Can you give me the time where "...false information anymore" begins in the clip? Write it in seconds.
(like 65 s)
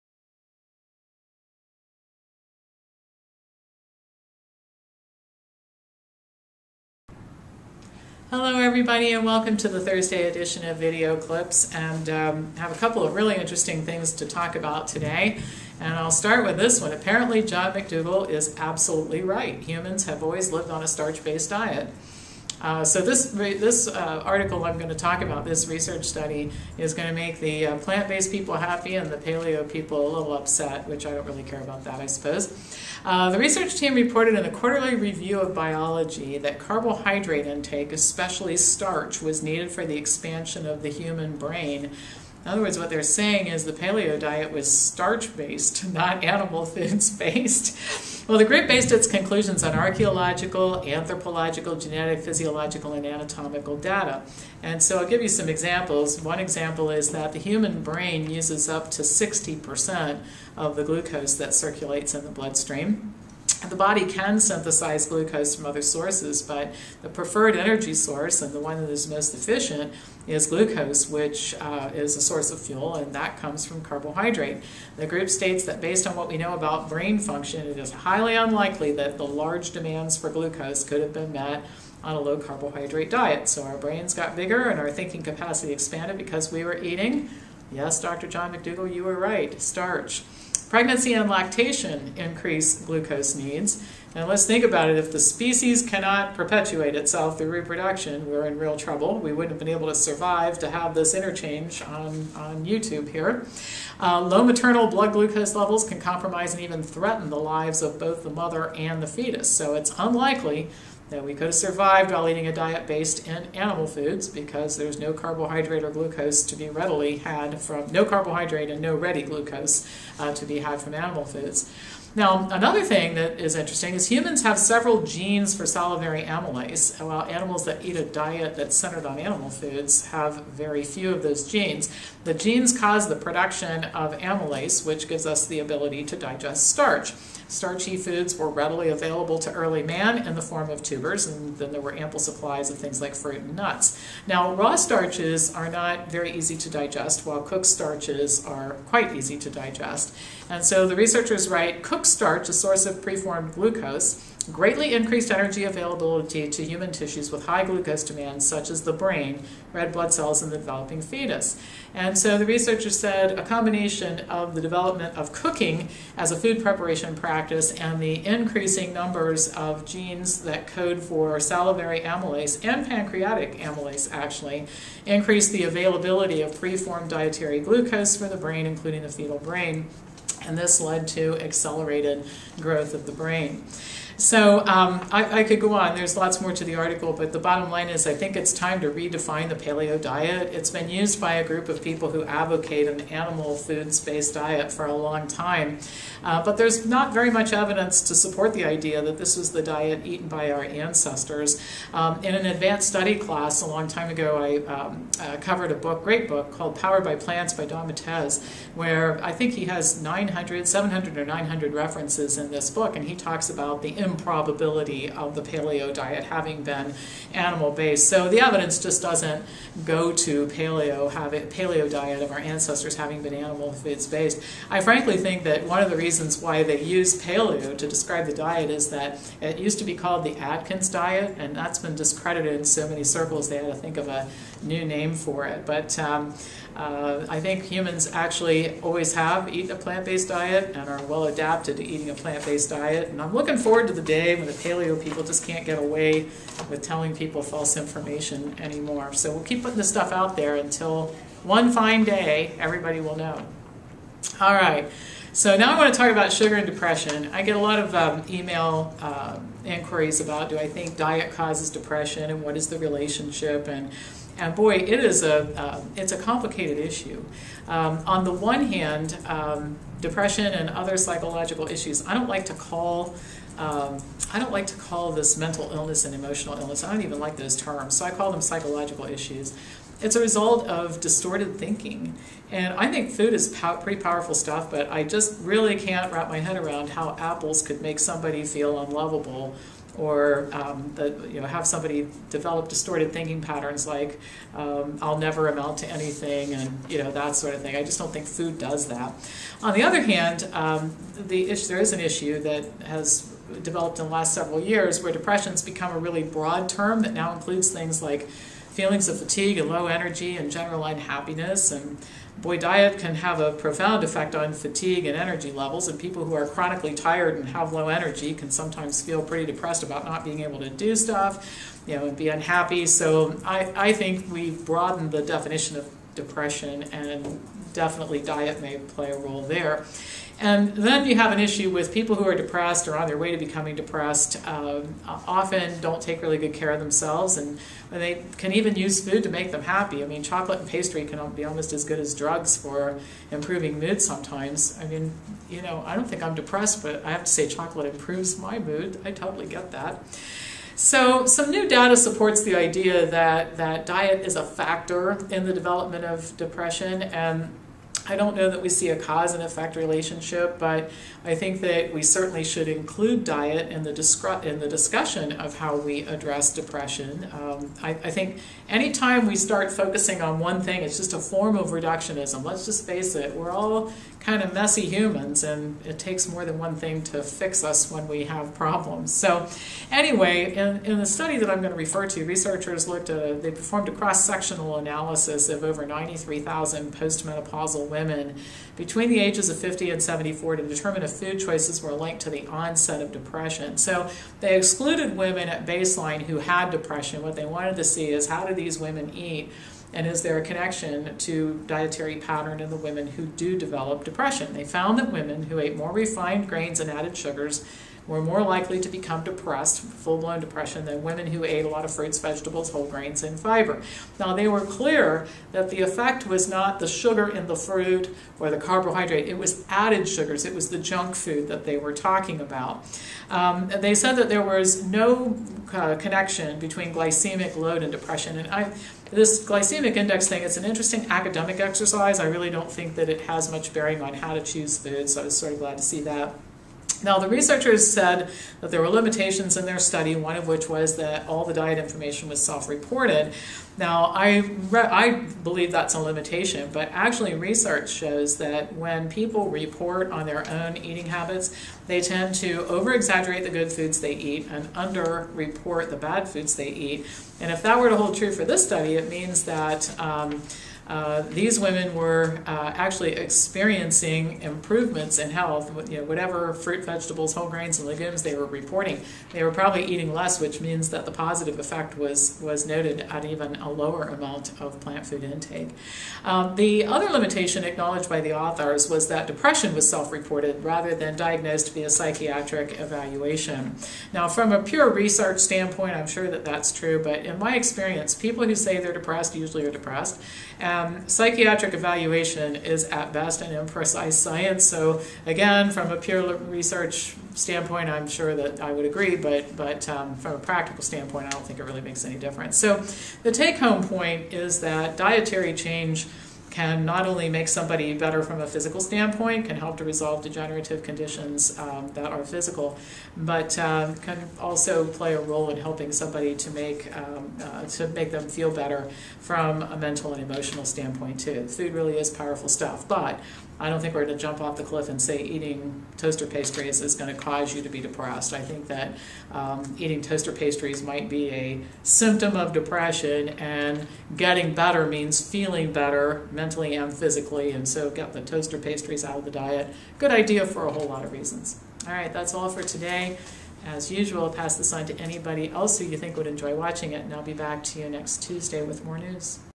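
247 s.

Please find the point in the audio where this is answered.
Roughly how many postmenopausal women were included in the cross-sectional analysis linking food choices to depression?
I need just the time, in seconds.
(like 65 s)
385 s.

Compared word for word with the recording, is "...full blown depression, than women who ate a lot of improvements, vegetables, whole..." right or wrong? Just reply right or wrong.
wrong.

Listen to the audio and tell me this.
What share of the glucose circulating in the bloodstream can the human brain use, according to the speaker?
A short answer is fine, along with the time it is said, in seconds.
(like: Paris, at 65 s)
up to 60%, at 58 s.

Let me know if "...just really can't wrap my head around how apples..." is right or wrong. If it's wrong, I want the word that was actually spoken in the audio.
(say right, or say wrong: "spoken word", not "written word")
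right.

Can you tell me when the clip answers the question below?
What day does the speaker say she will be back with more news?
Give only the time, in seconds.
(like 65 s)
547 s.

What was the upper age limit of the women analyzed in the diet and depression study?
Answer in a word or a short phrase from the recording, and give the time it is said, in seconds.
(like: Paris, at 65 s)
74, at 390 s.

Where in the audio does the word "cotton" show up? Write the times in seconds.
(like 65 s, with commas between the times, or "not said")
not said.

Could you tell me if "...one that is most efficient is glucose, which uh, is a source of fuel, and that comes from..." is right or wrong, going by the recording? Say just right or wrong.
right.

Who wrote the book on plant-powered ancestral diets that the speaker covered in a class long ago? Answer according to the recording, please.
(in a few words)
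Don Matesz.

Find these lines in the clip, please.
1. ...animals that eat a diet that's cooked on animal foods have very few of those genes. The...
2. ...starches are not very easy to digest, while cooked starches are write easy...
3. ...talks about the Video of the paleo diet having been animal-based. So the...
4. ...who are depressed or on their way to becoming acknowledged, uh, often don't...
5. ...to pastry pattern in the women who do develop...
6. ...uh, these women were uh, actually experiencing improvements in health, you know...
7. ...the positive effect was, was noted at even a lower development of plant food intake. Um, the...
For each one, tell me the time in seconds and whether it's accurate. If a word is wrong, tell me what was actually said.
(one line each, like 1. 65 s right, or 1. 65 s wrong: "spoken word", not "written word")
1. 127 s wrong: "centered", not "cooked"
2. 144 s wrong: "quite", not "write"
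3. 213 s wrong: "Probability", not "Video"
4. 332 s wrong: "depressed", not "acknowledged"
5. 401 s wrong: "dietary", not "pastry"
6. 460 s right
7. 471 s wrong: "amount", not "development".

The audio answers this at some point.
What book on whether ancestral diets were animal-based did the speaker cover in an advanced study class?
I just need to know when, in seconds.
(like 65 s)
206 s.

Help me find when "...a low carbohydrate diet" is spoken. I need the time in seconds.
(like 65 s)
82 s.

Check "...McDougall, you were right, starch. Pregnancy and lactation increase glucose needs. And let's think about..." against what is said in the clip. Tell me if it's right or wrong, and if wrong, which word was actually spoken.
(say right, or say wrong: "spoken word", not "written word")
right.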